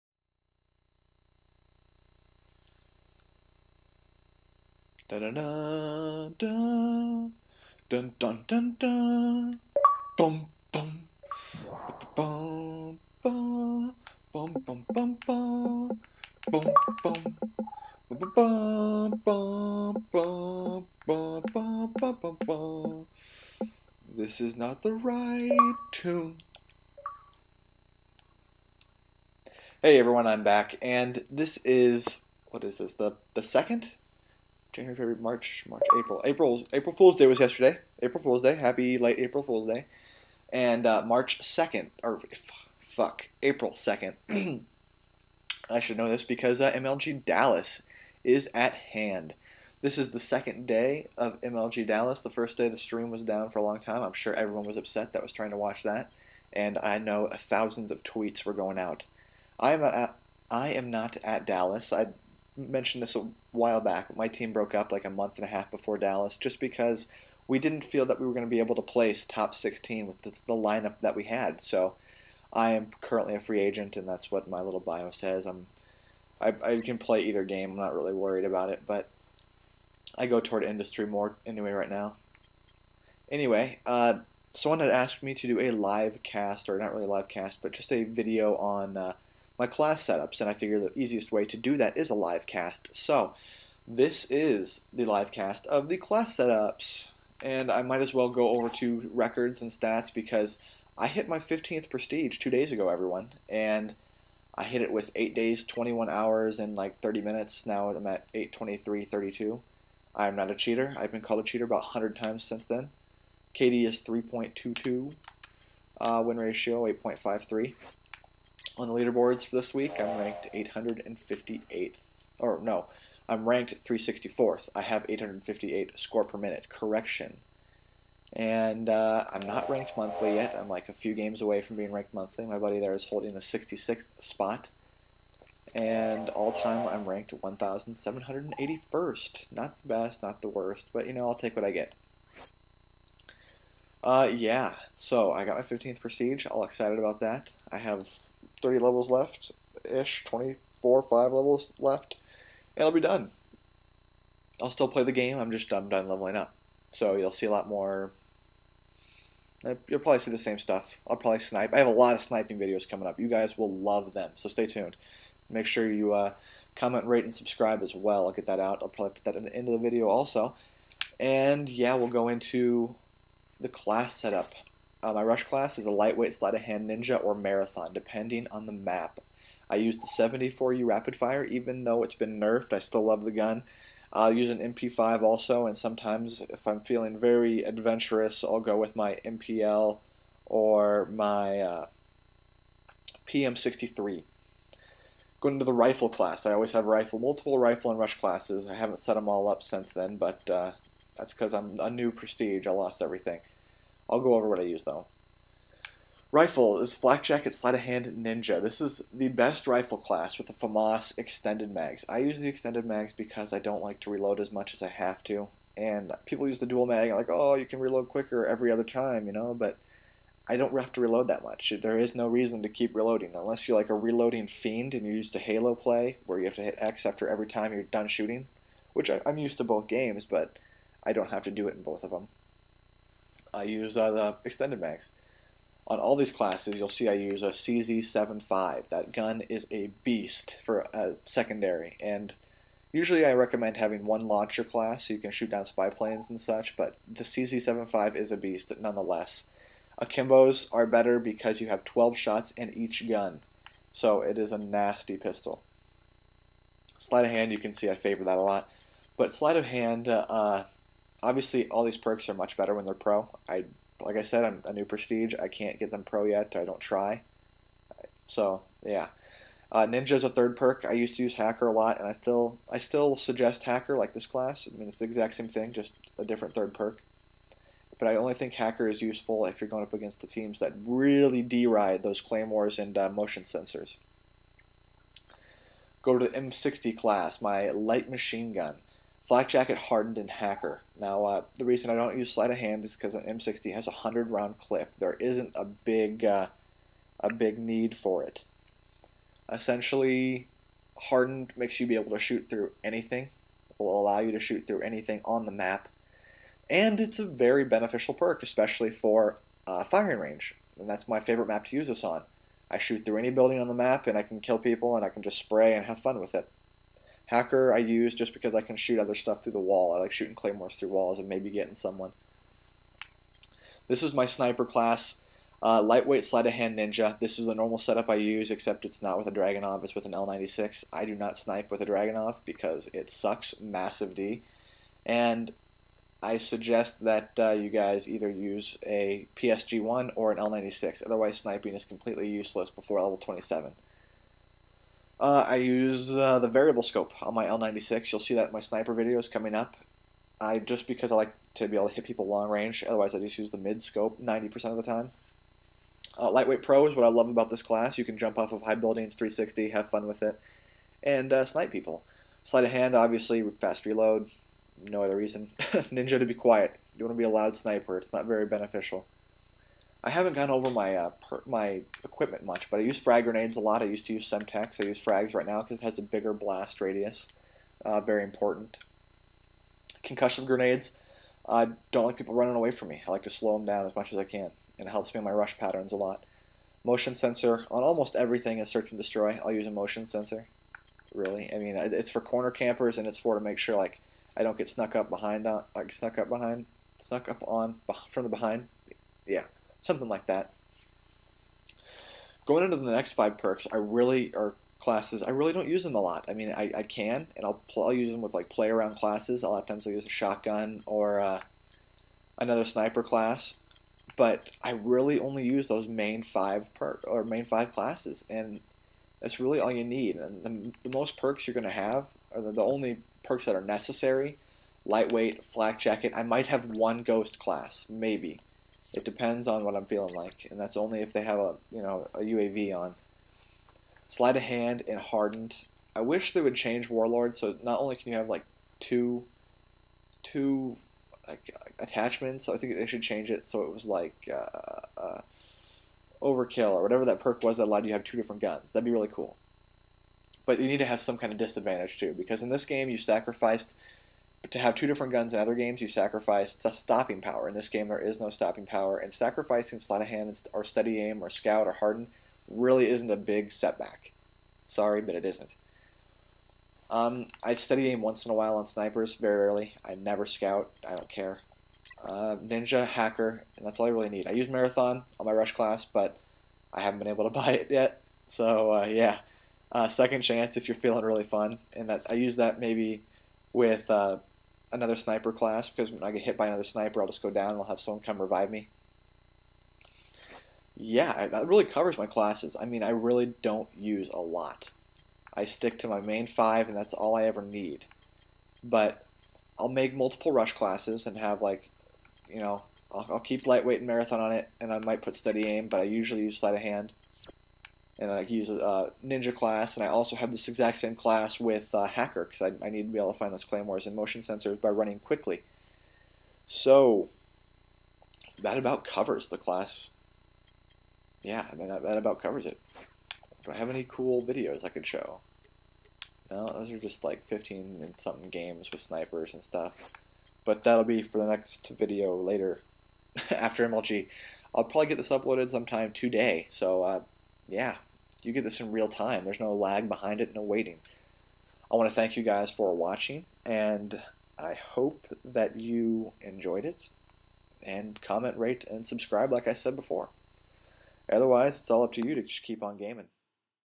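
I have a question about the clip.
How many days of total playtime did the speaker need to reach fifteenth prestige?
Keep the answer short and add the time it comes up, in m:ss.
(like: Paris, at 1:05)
8 days, at 1:45.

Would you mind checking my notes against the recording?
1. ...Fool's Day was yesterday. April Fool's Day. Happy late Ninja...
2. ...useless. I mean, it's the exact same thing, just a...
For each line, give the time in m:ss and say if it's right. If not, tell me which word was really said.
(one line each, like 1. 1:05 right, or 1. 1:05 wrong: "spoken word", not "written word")
1. 0:36 wrong: "April", not "Ninja"
2. 4:34 wrong: "class", not "useless".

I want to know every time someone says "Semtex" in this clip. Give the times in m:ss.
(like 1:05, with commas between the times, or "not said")
6:14.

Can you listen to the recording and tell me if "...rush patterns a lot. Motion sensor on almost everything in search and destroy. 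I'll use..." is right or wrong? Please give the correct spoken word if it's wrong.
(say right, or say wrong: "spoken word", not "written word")
right.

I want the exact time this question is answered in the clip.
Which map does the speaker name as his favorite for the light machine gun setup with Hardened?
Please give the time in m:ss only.
5:09.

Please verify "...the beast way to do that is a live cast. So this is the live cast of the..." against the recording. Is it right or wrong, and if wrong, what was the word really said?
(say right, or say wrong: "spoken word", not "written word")
wrong: "easiest", not "beast".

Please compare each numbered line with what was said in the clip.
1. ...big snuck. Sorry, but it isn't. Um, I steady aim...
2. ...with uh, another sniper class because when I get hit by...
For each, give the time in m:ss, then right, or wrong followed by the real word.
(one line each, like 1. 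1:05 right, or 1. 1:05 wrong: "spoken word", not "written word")
1. 7:43 wrong: "setback", not "snuck"
2. 8:03 right.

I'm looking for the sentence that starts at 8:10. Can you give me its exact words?
Yeah, that really covers my classes.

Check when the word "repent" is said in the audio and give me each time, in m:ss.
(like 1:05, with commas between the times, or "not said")
not said.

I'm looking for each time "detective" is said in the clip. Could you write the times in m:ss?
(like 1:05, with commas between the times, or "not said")
not said.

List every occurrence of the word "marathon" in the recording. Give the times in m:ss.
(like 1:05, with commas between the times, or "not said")
2:57, 7:54, 8:23.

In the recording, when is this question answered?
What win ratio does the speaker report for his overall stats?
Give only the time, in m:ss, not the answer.
1:56.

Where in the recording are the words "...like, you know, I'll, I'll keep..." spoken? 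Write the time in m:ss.
8:21.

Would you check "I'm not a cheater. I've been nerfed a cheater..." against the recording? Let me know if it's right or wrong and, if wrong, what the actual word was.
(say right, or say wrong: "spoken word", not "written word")
wrong: "called", not "nerfed".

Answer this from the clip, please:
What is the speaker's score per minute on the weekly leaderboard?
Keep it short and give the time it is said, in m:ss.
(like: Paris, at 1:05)
858, at 2:05.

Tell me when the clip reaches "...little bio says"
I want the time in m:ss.
1:14.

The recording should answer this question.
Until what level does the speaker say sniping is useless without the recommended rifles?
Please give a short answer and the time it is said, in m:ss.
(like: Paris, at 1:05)
27, at 5:43.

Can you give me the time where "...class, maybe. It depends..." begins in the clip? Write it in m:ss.
7:07.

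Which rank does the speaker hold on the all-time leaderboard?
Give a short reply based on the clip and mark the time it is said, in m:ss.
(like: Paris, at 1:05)
1,781st, at 2:17.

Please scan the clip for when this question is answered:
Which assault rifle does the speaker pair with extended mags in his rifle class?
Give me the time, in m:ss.
3:30.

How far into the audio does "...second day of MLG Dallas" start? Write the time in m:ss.
0:50.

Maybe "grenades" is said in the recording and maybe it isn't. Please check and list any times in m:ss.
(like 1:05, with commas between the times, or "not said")
6:13, 6:20.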